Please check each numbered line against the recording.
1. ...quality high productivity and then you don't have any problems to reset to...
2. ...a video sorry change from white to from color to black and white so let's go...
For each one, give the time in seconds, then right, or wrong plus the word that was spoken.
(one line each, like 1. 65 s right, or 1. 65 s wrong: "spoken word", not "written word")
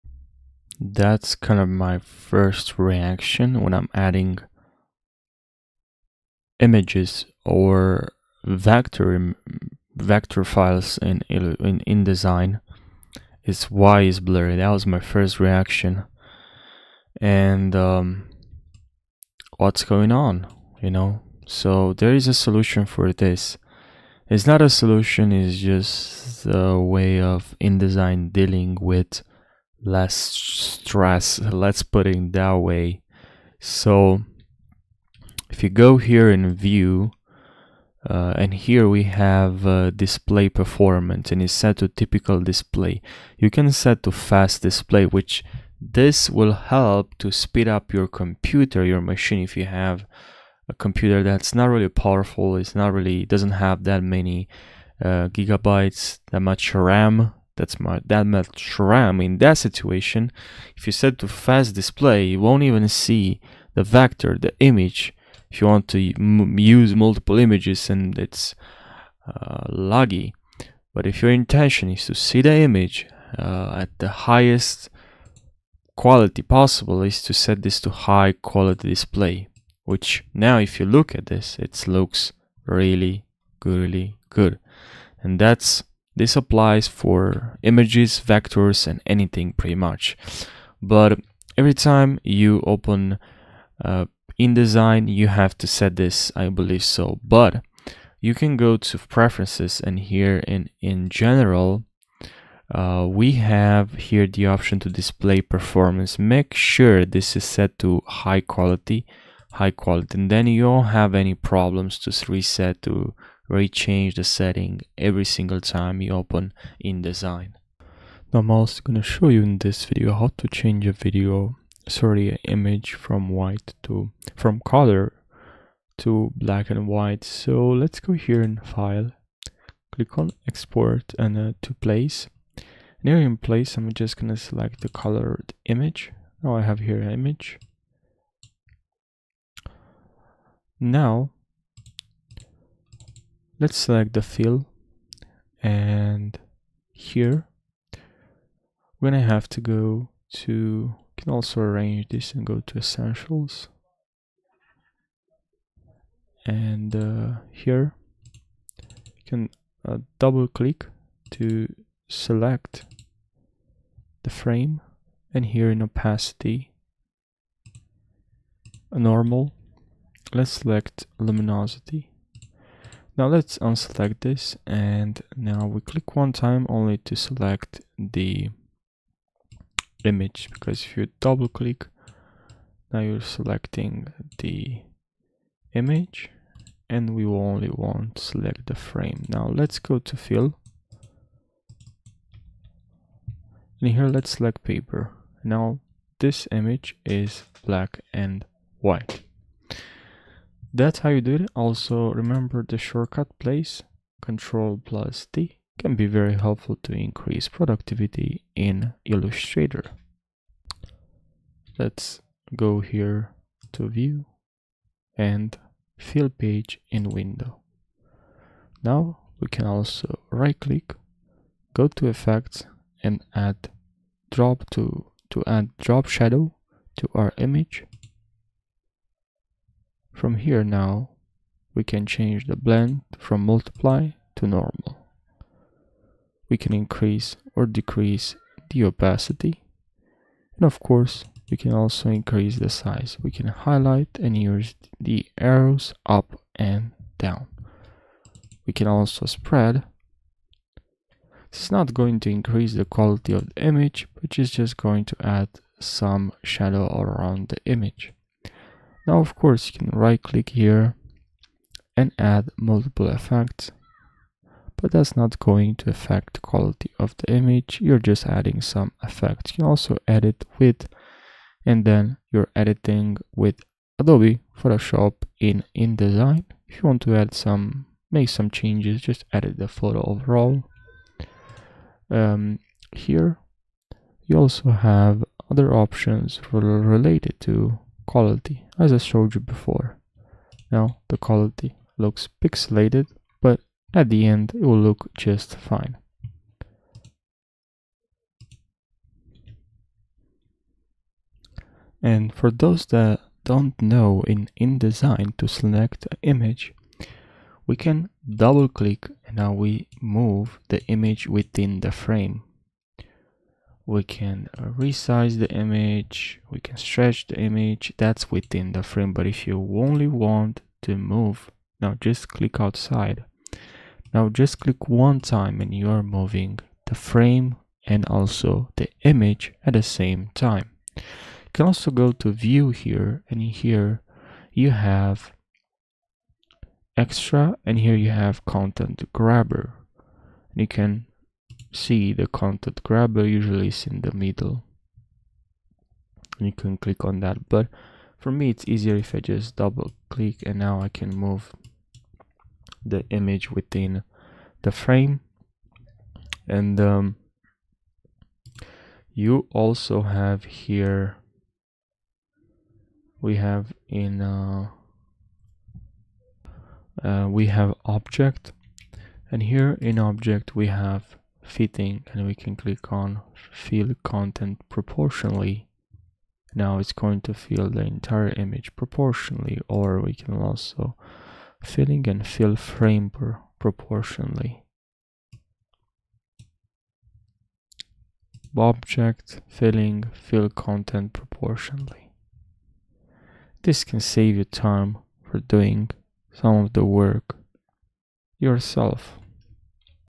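1. 108 s wrong: "quality", not "productivity"
2. 120 s wrong: "image", not "change".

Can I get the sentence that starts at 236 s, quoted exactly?
We can increase or decrease the opacity.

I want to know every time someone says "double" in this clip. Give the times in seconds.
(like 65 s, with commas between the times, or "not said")
160 s, 181 s, 308 s, 349 s.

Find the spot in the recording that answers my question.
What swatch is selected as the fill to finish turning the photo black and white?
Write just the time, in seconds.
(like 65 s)
194 s.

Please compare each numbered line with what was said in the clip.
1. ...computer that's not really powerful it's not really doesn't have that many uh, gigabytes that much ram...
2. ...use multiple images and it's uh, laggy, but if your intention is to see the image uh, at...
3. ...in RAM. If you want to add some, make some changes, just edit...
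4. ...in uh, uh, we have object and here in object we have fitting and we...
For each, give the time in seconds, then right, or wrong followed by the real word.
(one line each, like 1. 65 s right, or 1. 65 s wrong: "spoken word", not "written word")
1. 50 s right
2. 65 s right
3. 275 s wrong: "InDesign", not "RAM"
4. 363 s right.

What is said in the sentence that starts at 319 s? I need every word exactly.
But if you only want to move, now just click outside.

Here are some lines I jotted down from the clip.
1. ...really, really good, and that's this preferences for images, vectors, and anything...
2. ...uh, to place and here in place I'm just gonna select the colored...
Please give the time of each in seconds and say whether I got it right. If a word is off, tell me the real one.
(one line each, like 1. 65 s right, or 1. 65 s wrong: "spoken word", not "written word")
1. 82 s wrong: "applies", not "preferences"
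2. 131 s right.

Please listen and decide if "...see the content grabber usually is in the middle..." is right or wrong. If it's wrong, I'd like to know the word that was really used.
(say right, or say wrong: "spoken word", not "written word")
right.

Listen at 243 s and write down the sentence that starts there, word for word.
We can highlight and use the arrows up and down.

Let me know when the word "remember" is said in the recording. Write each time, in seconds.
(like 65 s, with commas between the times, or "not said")
202 s.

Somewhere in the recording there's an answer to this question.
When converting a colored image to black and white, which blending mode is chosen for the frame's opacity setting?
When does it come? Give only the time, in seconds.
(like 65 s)
171 s.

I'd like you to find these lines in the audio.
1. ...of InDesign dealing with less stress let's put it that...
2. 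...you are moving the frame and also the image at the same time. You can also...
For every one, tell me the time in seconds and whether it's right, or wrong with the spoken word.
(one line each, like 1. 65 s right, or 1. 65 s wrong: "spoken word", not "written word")
1. 27 s right
2. 325 s right.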